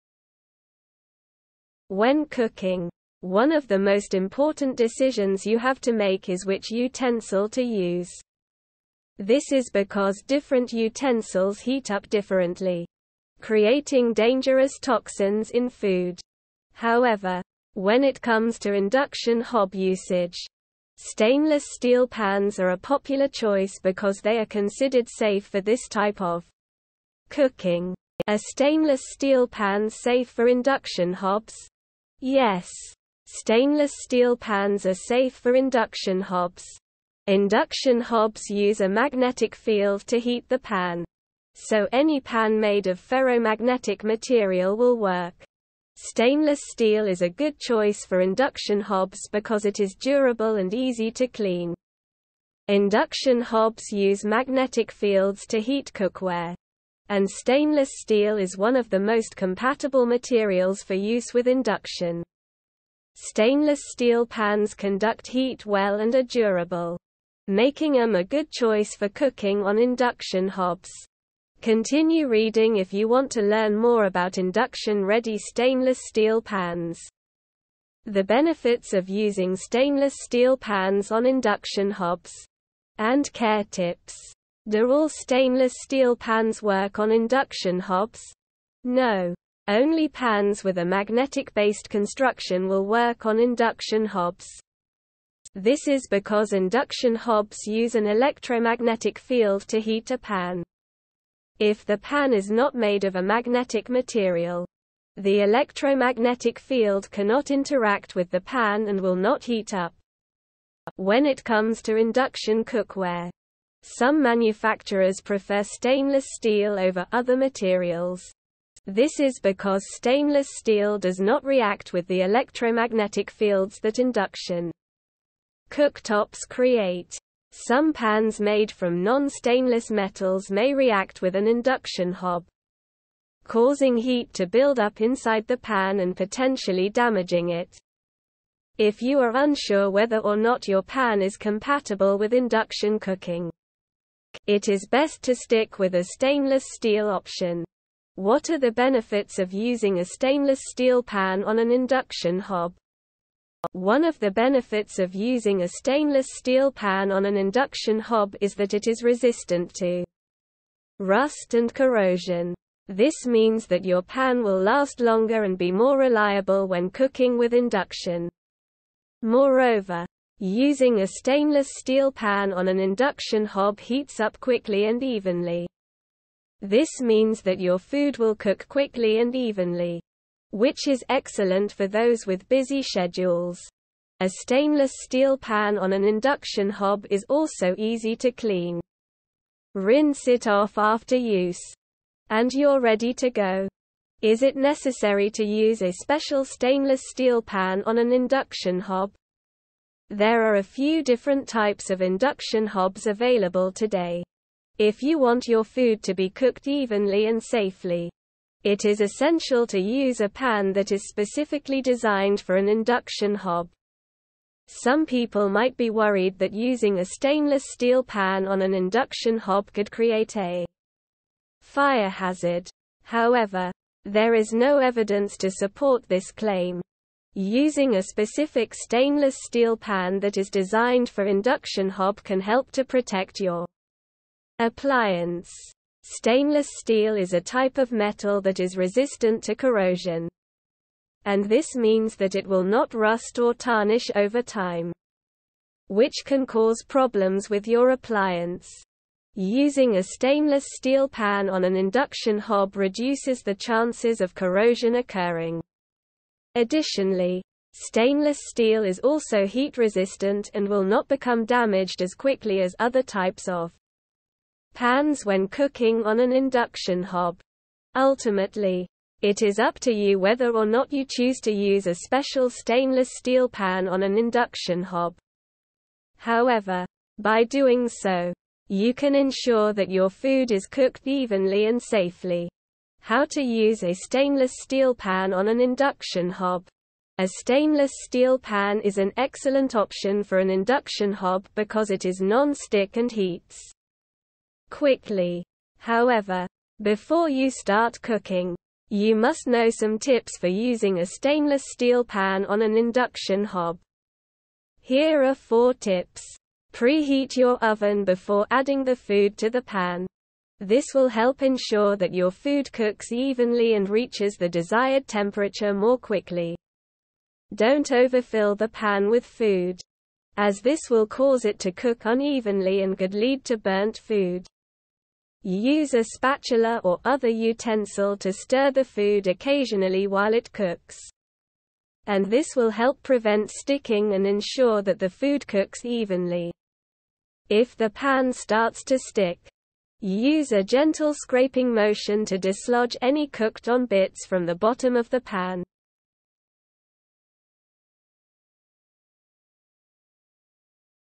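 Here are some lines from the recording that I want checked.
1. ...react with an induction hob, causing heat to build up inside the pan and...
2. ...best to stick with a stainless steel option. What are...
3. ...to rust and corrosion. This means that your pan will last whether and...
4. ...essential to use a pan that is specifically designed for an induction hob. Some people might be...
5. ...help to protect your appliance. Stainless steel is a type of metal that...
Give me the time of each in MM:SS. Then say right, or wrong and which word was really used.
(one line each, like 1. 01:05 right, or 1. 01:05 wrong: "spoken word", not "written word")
1. 02:10 right
2. 02:24 right
3. 02:39 wrong: "longer", not "whether"
4. 03:28 right
5. 03:52 right.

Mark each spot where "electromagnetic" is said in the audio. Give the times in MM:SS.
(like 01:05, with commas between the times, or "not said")
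01:38, 01:45, 02:02.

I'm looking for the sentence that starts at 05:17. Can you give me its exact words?
Don't overfill the pan with food, as this will cause it to cook unevenly and could lead to burnt food.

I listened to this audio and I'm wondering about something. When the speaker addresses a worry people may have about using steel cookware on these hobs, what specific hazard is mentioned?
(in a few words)
fire hazard.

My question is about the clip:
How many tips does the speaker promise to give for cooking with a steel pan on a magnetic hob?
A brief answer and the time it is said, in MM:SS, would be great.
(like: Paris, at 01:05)
4, at 05:05.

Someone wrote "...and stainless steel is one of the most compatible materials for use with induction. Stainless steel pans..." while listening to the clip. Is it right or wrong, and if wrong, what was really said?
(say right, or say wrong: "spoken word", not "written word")
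right.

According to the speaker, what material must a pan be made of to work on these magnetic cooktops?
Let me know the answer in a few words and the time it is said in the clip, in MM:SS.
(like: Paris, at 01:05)
ferromagnetic material, at 00:43.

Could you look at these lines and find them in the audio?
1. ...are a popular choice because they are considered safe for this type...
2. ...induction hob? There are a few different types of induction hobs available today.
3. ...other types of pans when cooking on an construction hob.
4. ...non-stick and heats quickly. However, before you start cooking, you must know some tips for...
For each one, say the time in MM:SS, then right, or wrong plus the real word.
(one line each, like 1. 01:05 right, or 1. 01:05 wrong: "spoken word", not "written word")
1. 00:22 right
2. 03:18 right
3. 04:22 wrong: "induction", not "construction"
4. 04:52 right.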